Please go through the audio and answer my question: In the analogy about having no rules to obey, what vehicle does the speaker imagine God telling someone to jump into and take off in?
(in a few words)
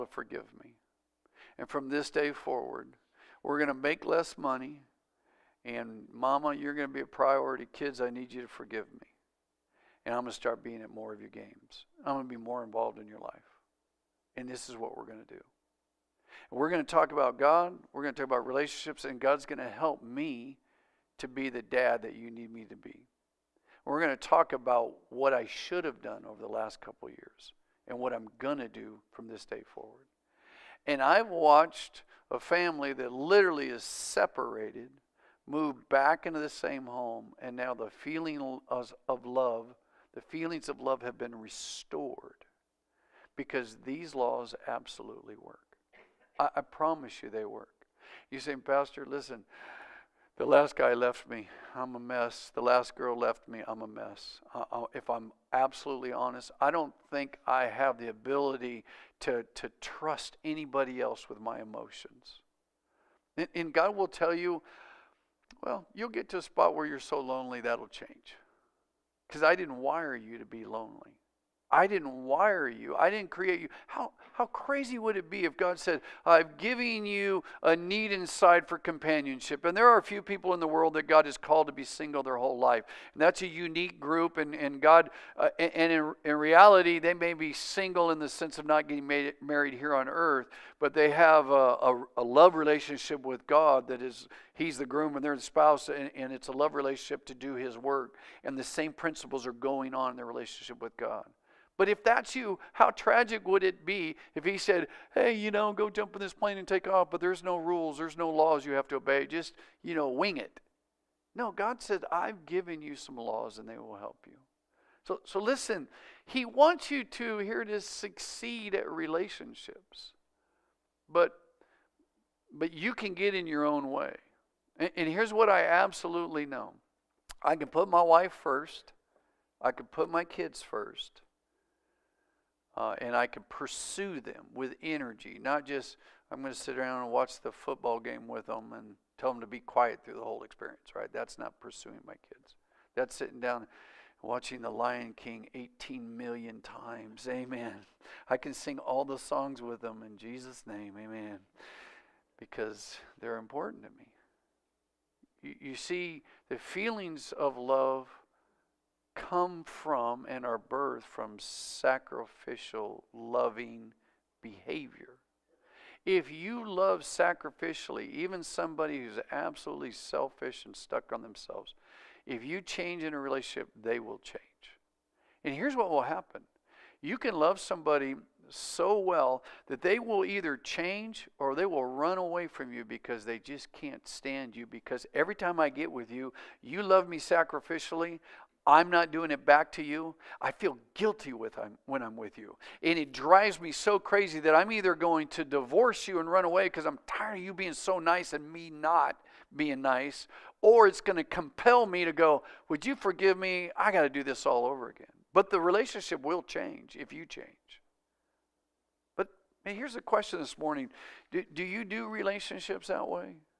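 plane.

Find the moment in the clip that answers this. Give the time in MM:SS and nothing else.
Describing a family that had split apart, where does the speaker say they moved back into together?
00:36.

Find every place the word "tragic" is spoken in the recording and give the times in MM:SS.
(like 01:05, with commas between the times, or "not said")
01:42.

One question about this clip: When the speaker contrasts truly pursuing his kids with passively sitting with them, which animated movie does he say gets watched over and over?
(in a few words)
The Lion King.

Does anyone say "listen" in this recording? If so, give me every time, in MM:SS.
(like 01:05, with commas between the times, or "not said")
00:49, 01:55.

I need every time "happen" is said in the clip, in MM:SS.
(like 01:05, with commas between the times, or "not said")
02:56.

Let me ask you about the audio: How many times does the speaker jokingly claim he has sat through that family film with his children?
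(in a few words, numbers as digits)
18 million.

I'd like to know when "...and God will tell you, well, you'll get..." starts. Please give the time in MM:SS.
01:03.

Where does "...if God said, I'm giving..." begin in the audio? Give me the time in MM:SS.
01:15.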